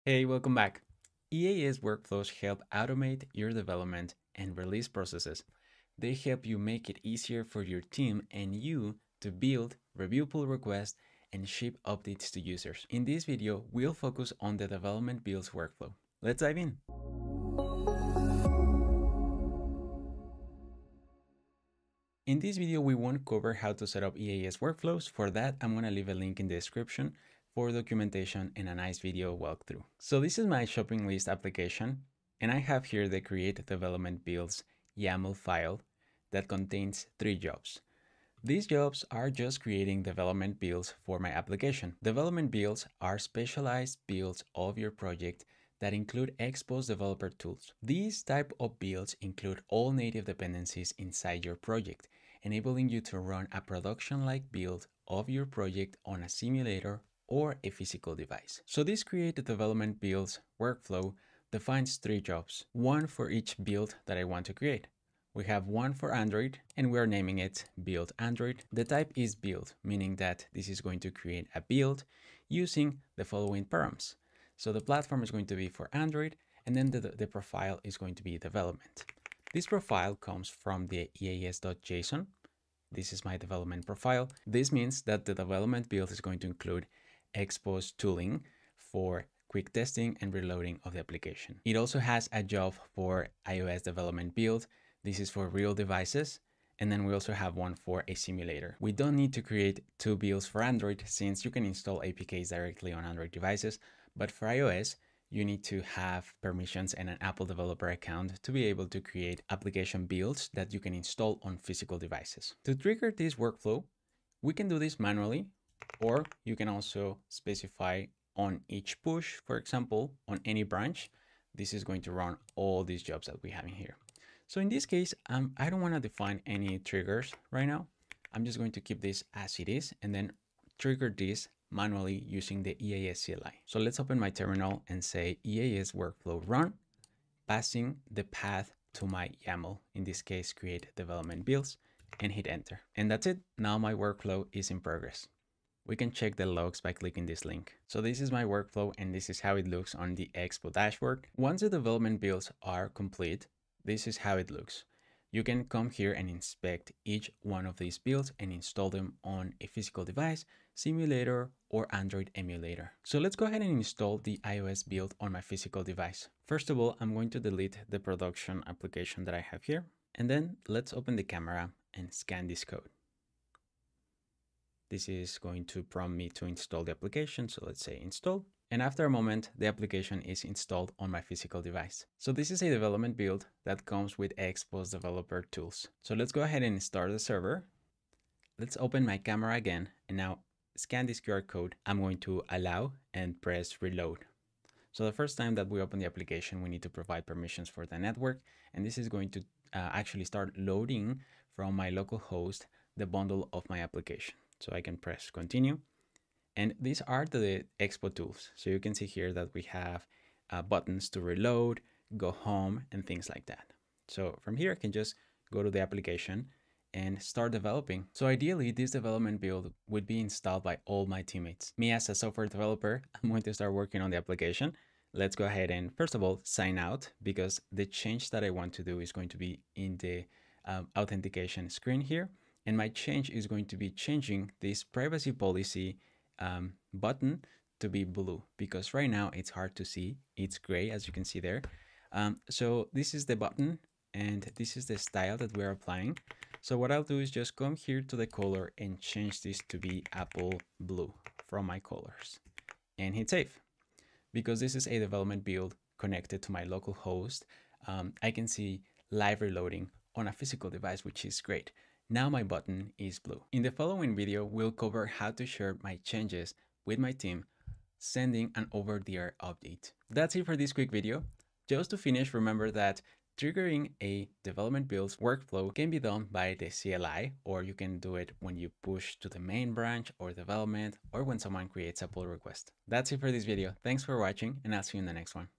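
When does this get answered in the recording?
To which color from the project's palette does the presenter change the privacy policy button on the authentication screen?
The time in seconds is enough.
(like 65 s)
250 s.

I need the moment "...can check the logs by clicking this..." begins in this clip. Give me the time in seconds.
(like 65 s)
145 s.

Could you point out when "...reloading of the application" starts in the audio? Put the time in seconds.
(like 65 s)
90 s.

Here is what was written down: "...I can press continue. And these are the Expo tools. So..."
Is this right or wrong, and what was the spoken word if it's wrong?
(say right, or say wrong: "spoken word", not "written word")
right.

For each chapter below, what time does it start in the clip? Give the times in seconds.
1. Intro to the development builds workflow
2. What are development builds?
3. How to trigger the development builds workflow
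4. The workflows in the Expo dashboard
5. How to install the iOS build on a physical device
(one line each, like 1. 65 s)
1. 22 s
2. 41 s
3. 111 s
4. 149 s
5. 163 s.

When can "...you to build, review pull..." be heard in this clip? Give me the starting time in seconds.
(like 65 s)
8 s.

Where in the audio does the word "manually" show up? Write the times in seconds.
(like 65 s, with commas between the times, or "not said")
114 s, 131 s.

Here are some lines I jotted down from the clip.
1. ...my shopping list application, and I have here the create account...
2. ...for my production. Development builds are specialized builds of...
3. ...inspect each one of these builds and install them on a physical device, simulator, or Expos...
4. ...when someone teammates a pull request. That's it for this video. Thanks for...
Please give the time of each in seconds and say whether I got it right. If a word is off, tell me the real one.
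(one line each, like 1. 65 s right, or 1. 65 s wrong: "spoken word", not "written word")
1. 30 s wrong: "development", not "account"
2. 41 s wrong: "application", not "production"
3. 156 s wrong: "Android", not "Expos"
4. 281 s wrong: "creates", not "teammates".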